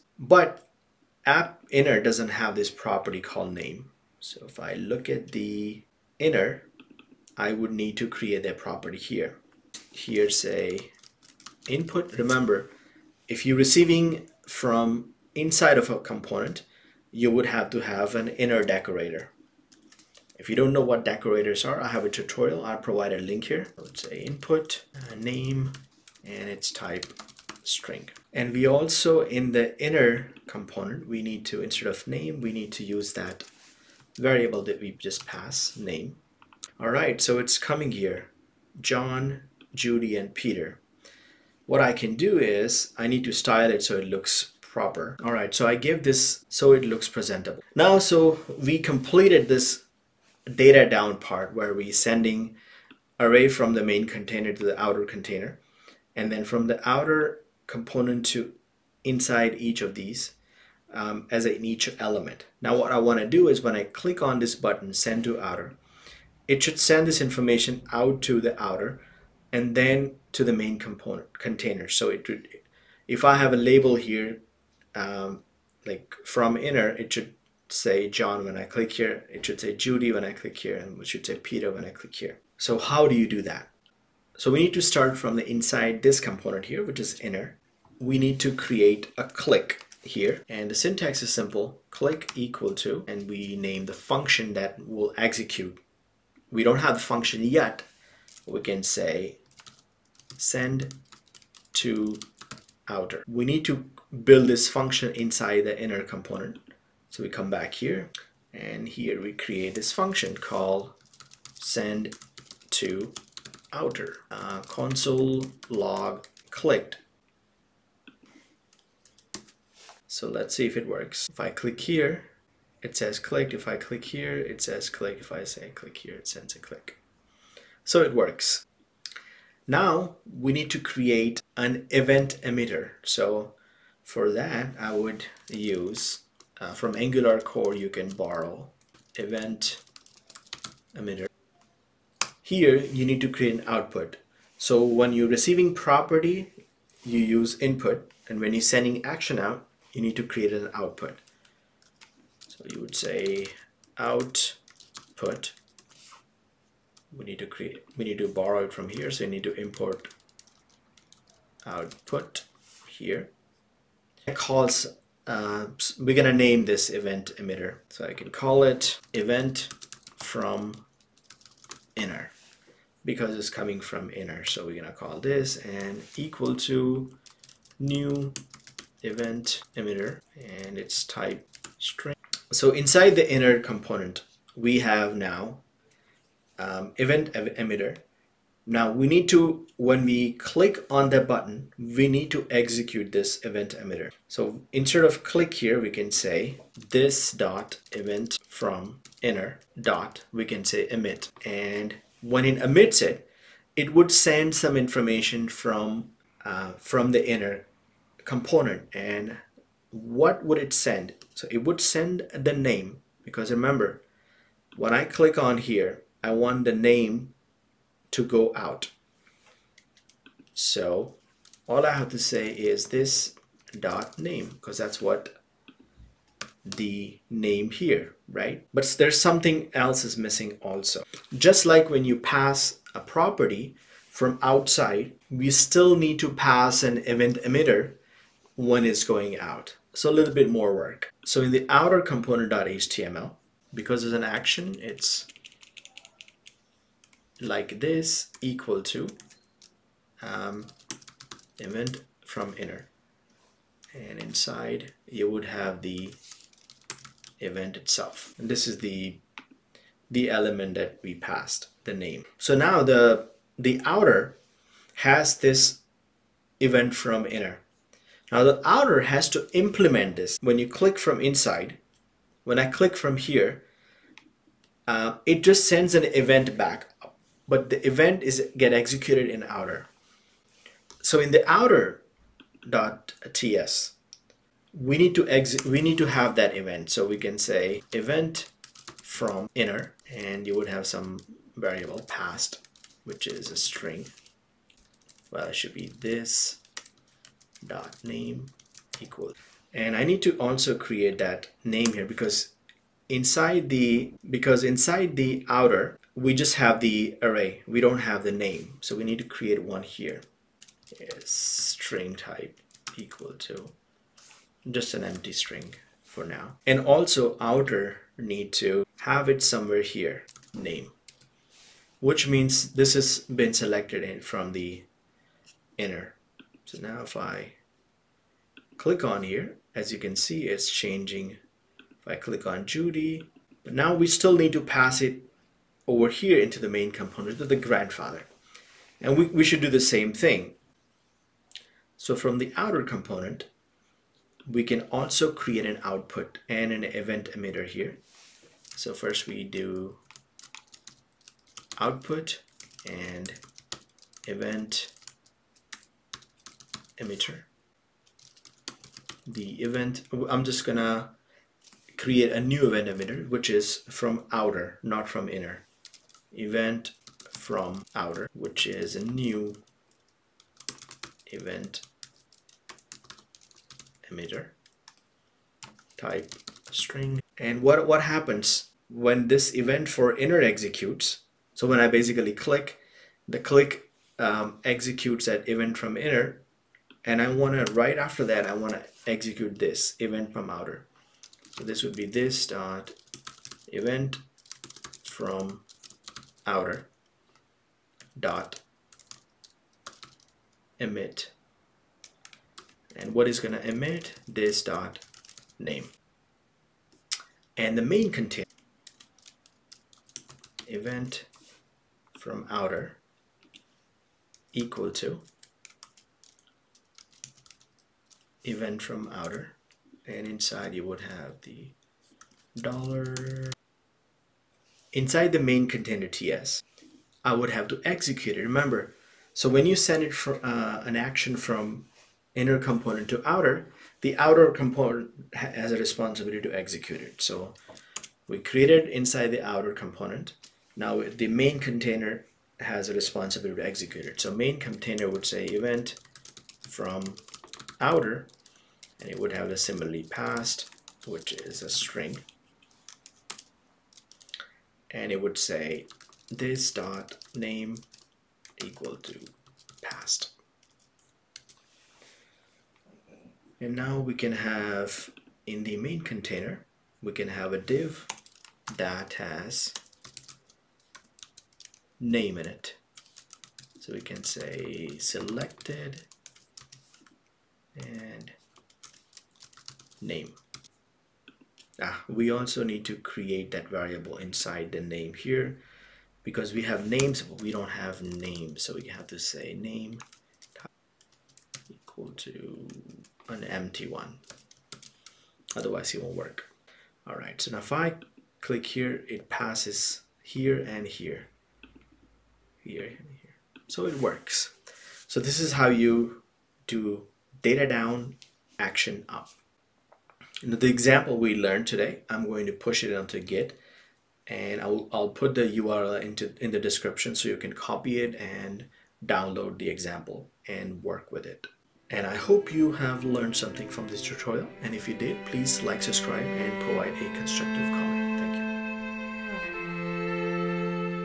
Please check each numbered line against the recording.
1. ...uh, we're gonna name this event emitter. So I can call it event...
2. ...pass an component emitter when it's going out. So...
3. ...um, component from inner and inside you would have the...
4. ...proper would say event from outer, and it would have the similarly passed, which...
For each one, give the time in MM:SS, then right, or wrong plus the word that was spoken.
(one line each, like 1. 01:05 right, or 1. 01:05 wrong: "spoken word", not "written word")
1. 02:45 right
2. 03:56 wrong: "event", not "component"
3. 04:10 wrong: "event", not "component"
4. 07:24 wrong: "container", not "proper".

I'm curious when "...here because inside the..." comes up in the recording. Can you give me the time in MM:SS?
05:01.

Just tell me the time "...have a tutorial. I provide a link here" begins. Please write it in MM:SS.
00:21.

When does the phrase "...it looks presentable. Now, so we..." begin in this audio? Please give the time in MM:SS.
00:46.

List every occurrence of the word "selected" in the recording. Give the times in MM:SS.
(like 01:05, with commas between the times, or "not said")
05:23, 07:54.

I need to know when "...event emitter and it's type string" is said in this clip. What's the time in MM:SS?
02:59.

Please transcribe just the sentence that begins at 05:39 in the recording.
And we, we should do the same thing.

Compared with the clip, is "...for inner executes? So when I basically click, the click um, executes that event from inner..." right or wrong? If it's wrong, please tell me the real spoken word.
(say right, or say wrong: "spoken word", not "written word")
right.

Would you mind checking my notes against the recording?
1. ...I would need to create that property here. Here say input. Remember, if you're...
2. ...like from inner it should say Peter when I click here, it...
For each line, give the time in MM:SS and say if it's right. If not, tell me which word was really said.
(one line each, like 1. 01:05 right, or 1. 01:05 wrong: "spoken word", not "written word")
1. 00:07 right
2. 01:15 wrong: "John", not "Peter".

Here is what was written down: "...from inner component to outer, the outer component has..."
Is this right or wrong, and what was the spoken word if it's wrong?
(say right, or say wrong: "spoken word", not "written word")
right.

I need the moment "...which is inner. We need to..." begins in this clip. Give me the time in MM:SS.
01:26.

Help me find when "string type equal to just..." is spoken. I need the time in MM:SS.
05:11.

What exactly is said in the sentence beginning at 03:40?
So all I have to say is this dot name because that's what the name here, right?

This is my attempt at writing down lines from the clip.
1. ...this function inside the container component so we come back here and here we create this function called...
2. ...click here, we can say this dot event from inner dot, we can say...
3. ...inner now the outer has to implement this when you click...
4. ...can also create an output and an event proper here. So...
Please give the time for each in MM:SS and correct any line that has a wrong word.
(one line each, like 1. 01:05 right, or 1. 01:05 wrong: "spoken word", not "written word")
1. 01:44 wrong: "inner", not "container"
2. 03:15 right
3. 04:27 right
4. 05:44 wrong: "emitter", not "proper".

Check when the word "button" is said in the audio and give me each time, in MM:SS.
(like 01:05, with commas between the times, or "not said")
01:04, 03:11.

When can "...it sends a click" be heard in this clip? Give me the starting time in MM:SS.
02:06.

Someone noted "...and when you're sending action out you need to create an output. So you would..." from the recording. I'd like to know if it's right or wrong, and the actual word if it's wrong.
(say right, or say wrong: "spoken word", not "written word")
right.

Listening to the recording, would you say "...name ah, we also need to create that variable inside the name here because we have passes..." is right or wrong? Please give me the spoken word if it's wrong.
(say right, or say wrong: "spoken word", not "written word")
wrong: "names", not "passes".